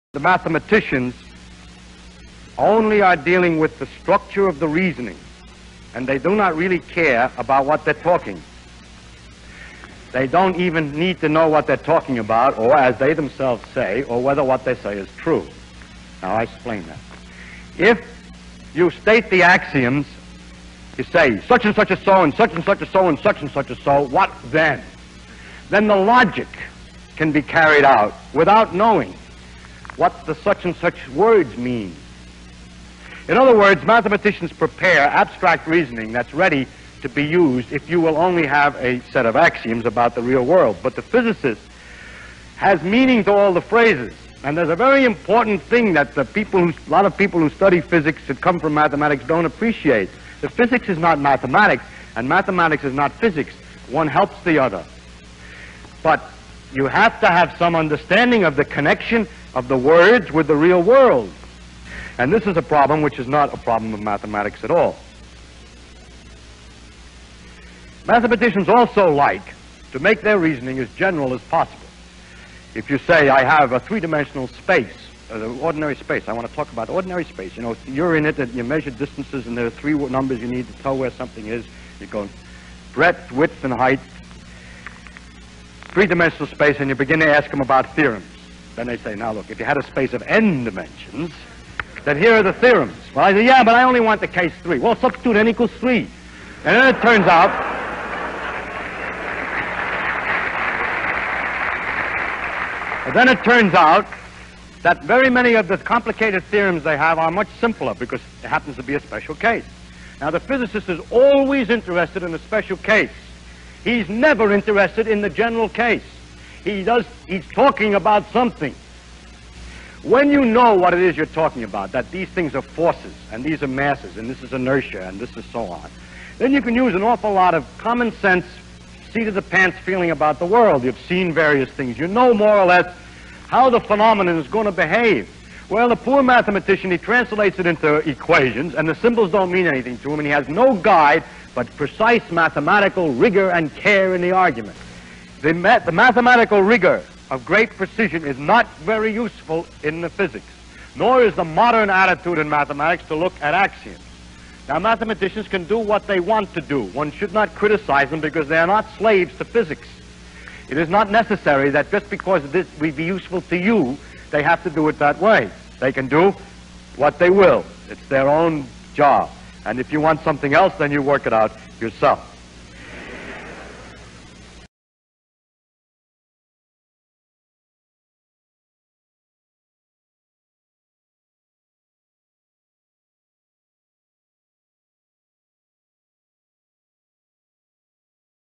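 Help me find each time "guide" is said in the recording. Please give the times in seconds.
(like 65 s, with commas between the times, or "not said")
140 s.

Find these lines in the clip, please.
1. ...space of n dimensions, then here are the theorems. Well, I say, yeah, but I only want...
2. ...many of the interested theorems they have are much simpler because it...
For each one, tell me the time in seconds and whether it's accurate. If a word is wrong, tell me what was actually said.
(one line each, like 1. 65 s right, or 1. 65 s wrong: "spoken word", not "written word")
1. 89 s right
2. 105 s wrong: "complicated", not "interested".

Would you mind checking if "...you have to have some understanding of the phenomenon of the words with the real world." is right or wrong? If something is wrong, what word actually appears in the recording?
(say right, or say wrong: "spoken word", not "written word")
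wrong: "connection", not "phenomenon".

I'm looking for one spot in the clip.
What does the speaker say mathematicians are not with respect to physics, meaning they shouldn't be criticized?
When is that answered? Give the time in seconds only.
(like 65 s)
158 s.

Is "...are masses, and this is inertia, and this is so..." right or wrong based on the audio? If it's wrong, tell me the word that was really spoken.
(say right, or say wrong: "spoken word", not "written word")
right.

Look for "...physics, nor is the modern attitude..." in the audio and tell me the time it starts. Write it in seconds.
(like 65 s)
150 s.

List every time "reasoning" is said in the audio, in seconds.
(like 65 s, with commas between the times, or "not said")
4 s, 35 s, 70 s.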